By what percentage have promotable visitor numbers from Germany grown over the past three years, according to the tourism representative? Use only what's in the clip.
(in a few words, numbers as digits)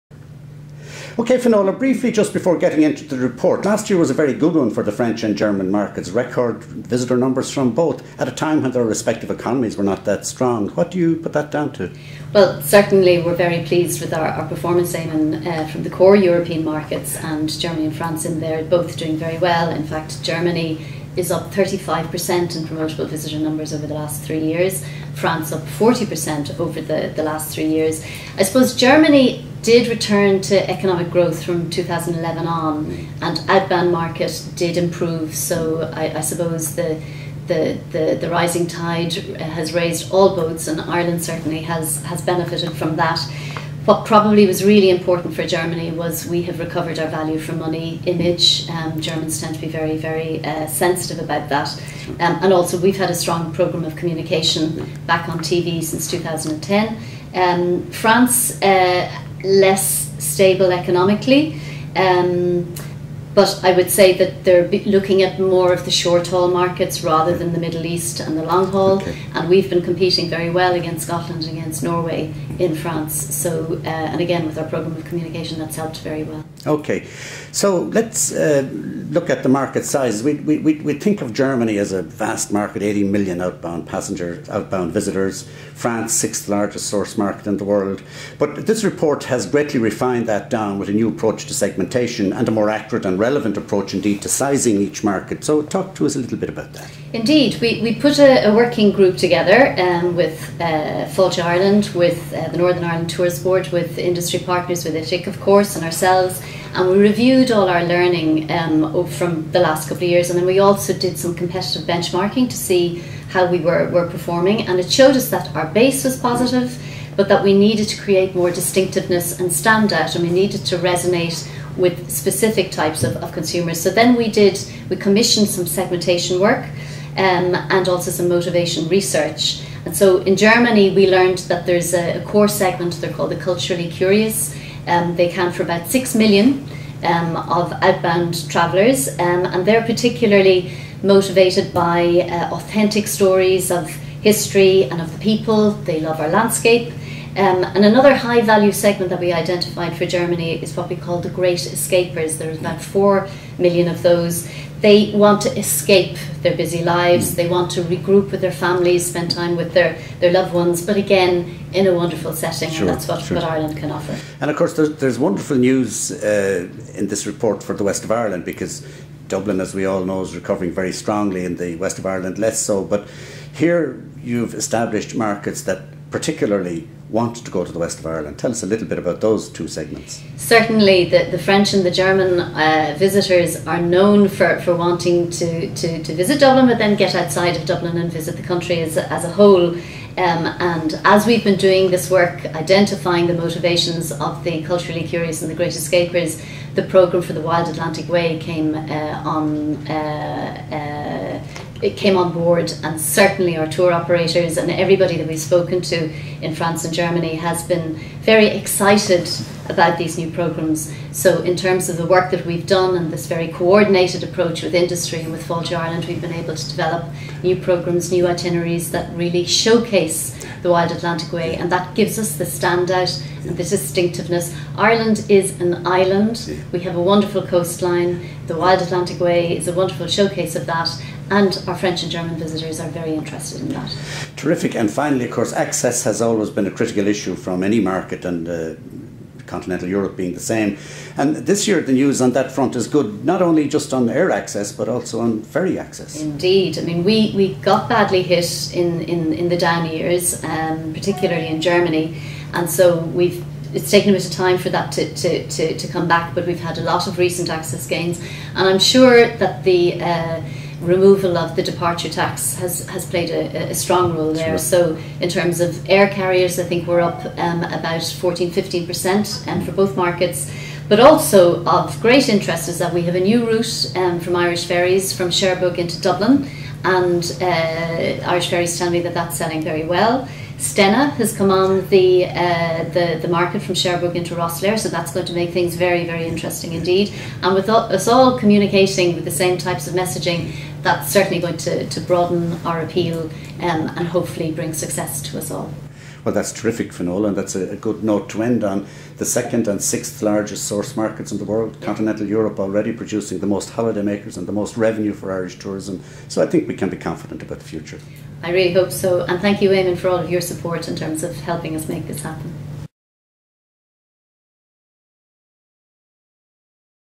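35%.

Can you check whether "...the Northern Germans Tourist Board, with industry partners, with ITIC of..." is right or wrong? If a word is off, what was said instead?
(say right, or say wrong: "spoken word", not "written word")
wrong: "Ireland", not "Germans".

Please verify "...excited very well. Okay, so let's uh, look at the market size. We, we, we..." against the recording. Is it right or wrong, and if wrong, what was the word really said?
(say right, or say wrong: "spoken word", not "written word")
wrong: "helped", not "excited".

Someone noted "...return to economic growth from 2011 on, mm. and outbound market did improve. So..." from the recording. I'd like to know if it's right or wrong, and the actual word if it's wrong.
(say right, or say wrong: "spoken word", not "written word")
right.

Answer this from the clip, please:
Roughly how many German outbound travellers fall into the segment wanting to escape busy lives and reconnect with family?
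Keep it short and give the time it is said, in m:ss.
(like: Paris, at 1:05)
4 million, at 2:32.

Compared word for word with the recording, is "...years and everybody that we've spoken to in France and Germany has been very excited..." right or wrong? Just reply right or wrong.
wrong.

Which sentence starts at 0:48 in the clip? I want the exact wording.
Um, Germans tend to be very, very uh, sensitive about that.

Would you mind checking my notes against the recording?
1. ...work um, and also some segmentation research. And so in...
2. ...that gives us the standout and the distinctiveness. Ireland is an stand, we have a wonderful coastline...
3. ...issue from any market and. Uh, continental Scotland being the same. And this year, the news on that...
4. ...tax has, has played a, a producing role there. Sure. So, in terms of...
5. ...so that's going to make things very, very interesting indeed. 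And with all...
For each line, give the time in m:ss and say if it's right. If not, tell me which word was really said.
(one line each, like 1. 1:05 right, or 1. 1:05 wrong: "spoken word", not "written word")
1. 2:06 wrong: "motivation", not "segmentation"
2. 3:41 wrong: "island", not "stand"
3. 3:57 wrong: "Europe", not "Scotland"
4. 4:22 wrong: "strong", not "producing"
5. 4:44 right.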